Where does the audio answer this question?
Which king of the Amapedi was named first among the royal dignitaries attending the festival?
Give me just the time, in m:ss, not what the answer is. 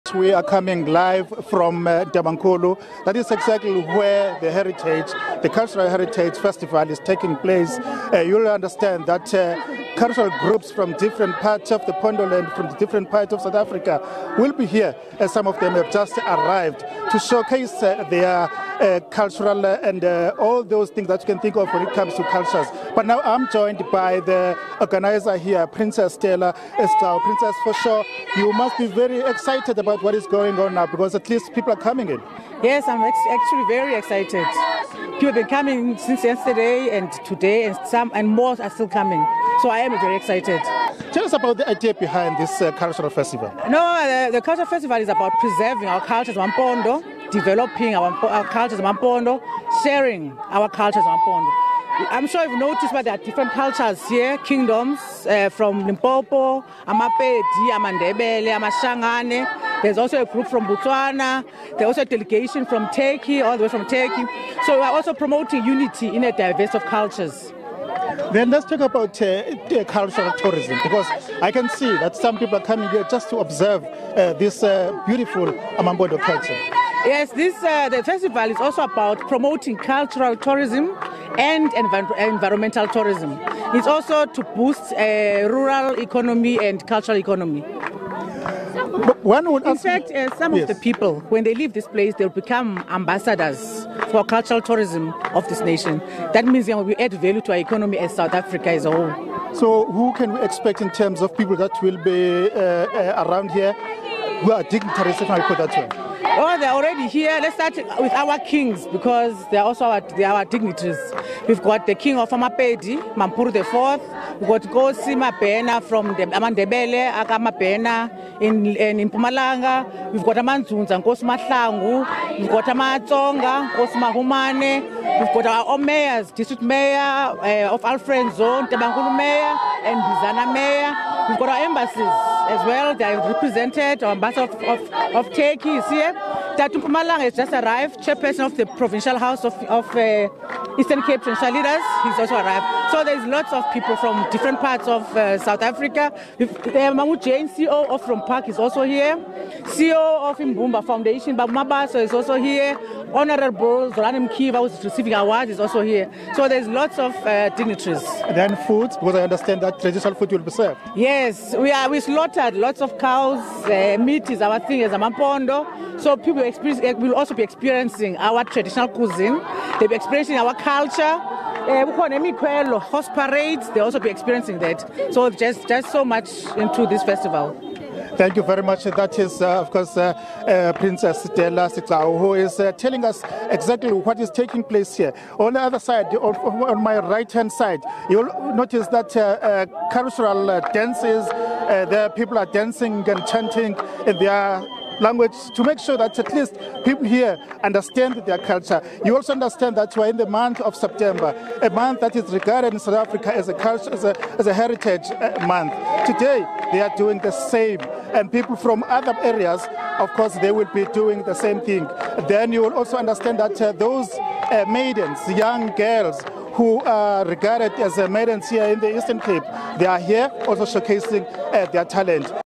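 1:53.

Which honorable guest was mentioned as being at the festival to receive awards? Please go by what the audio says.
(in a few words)
Zolan Mkiva.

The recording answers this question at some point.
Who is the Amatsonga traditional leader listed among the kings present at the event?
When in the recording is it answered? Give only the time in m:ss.
2:03.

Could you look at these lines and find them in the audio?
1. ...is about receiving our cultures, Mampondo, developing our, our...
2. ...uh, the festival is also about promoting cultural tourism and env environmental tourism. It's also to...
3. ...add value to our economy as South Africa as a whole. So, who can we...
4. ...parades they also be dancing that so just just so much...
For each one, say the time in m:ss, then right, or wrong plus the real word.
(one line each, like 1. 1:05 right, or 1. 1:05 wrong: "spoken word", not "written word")
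1. 0:44 wrong: "preserving", not "receiving"
2. 1:17 right
3. 1:36 right
4. 2:53 wrong: "experiencing", not "dancing".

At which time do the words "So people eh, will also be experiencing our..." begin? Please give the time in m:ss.
2:46.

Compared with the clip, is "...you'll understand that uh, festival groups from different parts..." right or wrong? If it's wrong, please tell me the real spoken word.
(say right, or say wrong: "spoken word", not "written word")
wrong: "cultural", not "festival".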